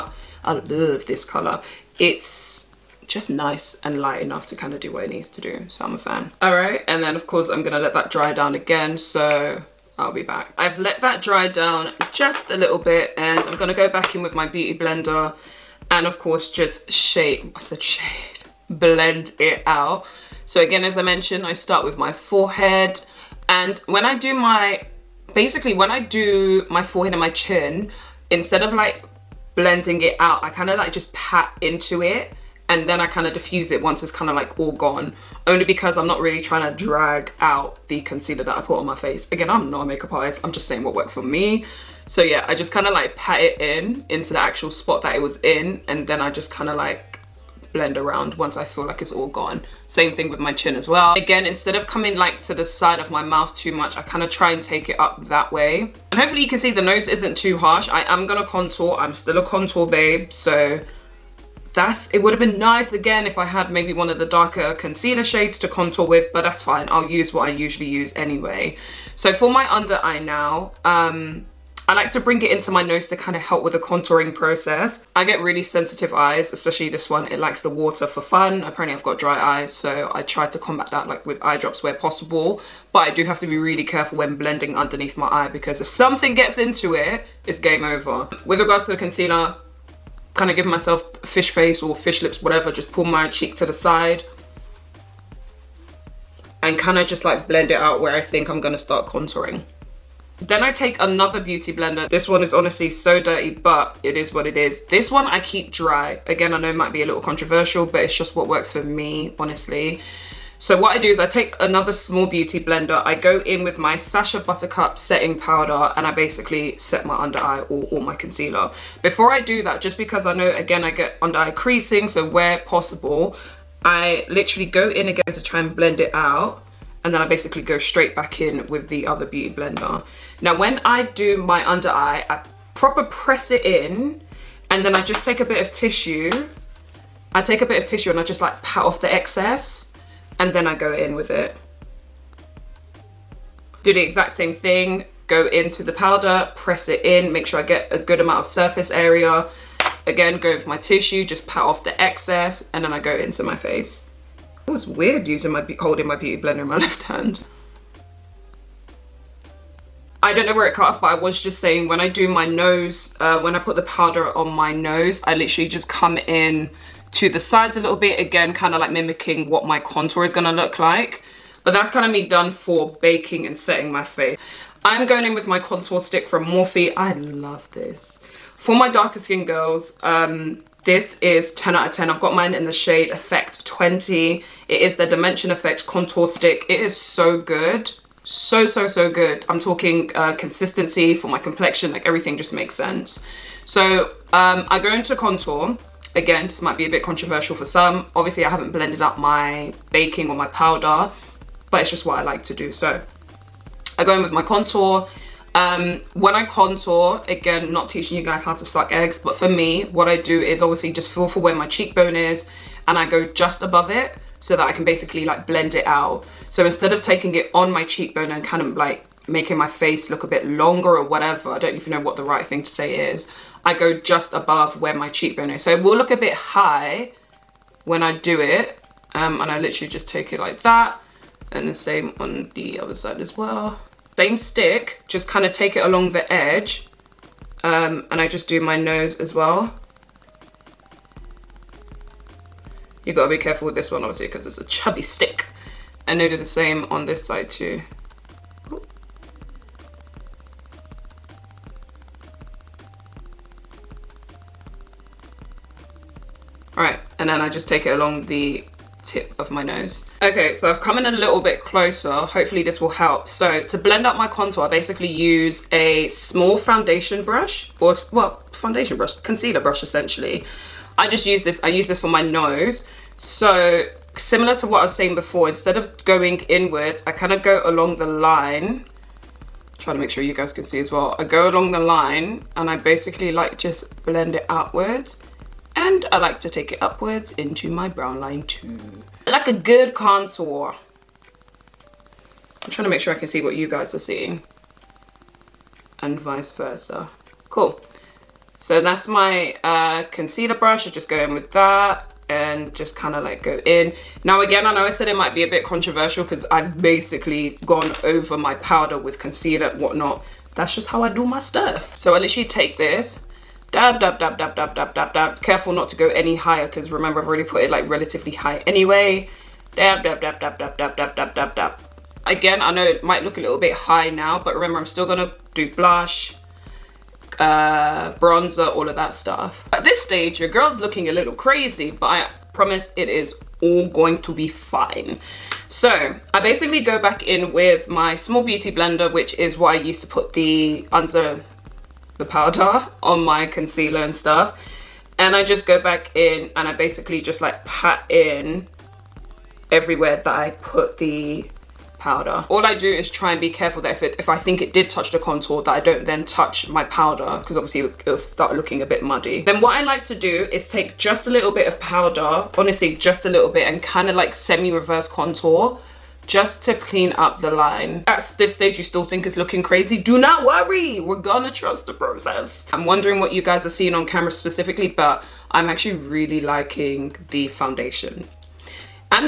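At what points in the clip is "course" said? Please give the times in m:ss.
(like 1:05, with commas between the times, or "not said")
0:07, 0:16.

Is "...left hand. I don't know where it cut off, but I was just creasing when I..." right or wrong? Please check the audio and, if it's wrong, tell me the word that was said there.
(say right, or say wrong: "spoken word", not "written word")
wrong: "saying", not "creasing".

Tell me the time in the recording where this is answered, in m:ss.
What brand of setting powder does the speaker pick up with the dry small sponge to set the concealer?
1:53.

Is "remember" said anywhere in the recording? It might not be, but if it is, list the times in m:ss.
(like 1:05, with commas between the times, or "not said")
5:16, 5:24.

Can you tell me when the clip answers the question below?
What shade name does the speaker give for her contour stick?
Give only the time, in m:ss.
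3:03.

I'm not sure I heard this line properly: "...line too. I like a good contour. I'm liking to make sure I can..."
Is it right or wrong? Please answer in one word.
wrong.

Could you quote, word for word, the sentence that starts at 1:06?
I'll use what I usually use anyway.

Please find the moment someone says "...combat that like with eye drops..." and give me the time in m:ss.
1:20.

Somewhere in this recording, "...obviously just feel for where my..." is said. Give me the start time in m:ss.
3:30.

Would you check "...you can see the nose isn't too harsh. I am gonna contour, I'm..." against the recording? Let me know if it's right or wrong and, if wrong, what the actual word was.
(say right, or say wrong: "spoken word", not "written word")
right.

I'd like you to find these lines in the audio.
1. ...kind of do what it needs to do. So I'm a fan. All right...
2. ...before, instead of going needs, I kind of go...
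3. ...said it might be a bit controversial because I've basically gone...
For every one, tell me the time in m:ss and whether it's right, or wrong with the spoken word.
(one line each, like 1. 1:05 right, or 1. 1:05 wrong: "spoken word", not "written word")
1. 0:04 right
2. 4:35 wrong: "inwards", not "needs"
3. 5:04 right.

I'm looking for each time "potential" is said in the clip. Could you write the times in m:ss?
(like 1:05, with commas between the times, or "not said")
not said.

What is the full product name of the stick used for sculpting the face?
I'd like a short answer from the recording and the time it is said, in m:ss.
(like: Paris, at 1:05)
Dimension Effect Contour Stick, at 3:05.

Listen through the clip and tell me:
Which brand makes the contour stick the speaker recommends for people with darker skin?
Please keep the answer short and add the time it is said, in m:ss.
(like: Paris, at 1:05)
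Morphe, at 2:56.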